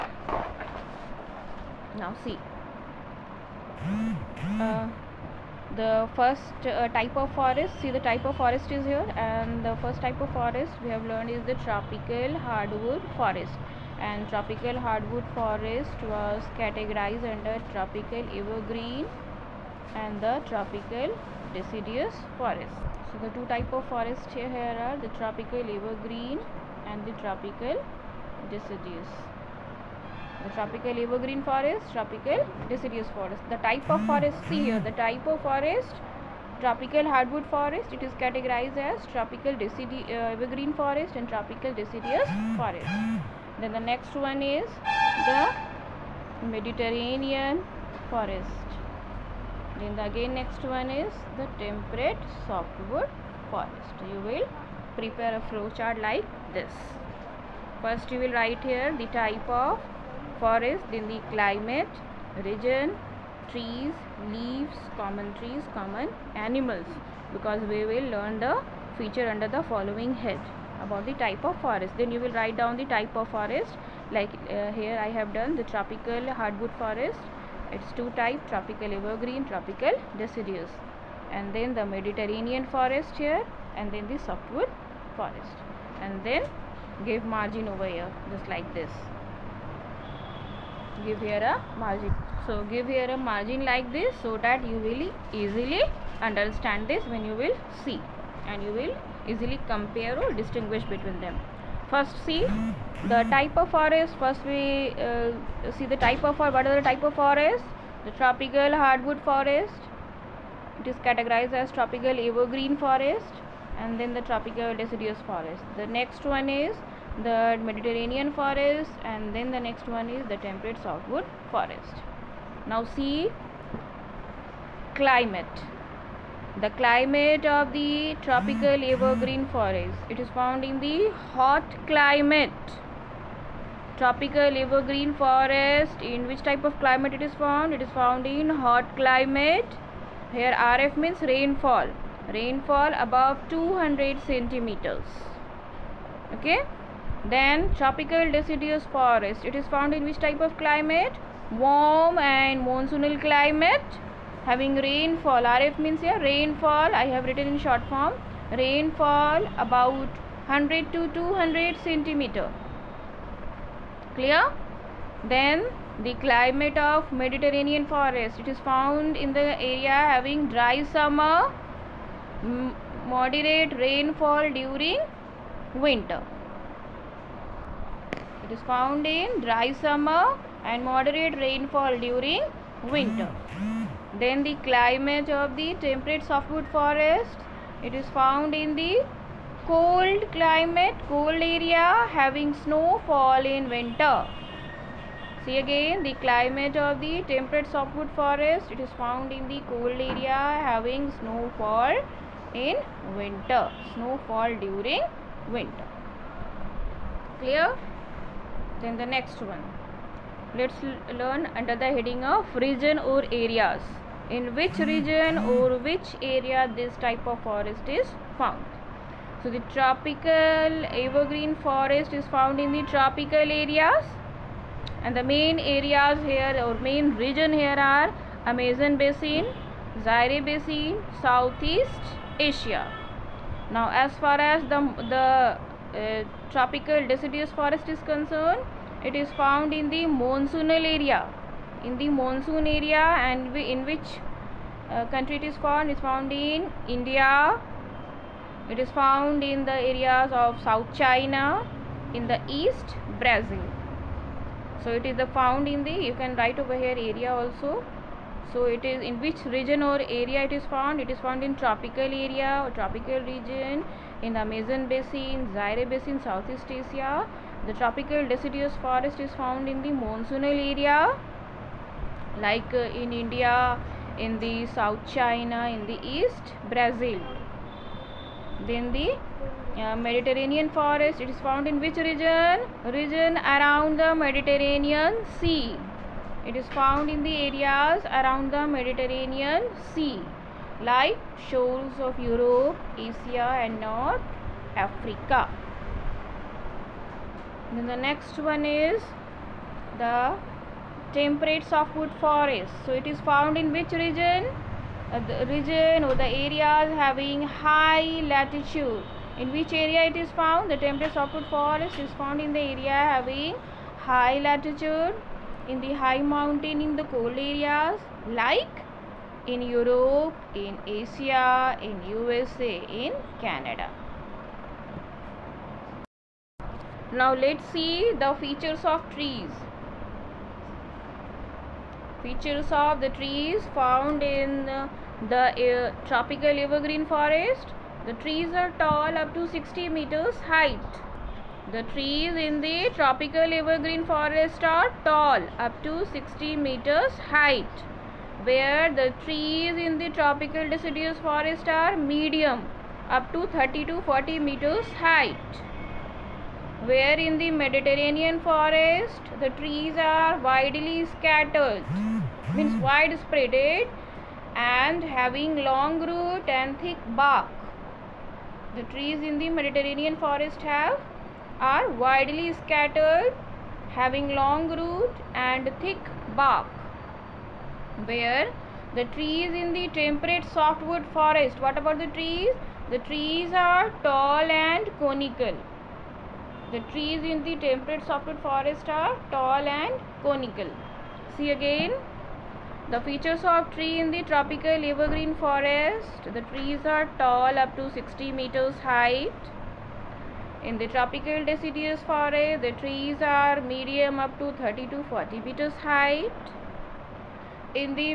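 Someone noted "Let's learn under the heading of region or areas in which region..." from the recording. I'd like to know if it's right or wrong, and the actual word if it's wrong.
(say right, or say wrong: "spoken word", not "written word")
right.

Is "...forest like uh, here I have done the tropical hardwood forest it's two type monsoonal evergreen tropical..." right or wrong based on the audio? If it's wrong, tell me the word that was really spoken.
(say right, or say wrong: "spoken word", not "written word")
wrong: "tropical", not "monsoonal".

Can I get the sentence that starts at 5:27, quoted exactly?
Now let's see the features of trees.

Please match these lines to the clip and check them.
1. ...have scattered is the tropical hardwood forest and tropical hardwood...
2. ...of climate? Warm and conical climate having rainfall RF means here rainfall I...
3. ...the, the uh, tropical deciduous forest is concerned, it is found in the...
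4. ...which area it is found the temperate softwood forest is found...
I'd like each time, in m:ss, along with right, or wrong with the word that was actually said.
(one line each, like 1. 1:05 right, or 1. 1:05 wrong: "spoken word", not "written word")
1. 0:10 wrong: "learned", not "scattered"
2. 2:30 wrong: "monsoonal", not "conical"
3. 3:54 right
4. 5:09 right.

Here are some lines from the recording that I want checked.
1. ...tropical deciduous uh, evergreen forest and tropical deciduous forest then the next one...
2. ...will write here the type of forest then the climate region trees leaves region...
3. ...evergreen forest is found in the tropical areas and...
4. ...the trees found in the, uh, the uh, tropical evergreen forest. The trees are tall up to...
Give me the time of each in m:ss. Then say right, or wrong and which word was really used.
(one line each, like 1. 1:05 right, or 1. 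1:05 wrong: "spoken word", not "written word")
1. 0:39 right
2. 0:58 wrong: "common", not "region"
3. 3:40 right
4. 5:33 right.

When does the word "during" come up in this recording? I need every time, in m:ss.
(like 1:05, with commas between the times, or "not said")
2:54, 3:02, 3:24.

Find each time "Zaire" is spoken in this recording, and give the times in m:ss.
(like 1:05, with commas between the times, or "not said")
3:50, 4:25.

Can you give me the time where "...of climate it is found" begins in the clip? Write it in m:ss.
2:16.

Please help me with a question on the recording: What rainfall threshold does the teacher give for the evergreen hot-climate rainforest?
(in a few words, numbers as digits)
above 200 centimeters.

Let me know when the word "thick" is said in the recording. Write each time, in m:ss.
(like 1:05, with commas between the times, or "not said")
6:06, 6:15.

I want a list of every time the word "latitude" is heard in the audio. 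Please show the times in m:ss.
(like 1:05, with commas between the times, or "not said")
5:08, 5:14.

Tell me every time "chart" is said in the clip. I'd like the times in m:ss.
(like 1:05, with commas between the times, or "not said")
0:55.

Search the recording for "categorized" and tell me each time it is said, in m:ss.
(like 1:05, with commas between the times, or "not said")
0:16, 0:38, 1:51.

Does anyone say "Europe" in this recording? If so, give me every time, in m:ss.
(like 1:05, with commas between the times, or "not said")
4:52, 5:19.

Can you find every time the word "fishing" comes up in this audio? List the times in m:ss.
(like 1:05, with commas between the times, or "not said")
not said.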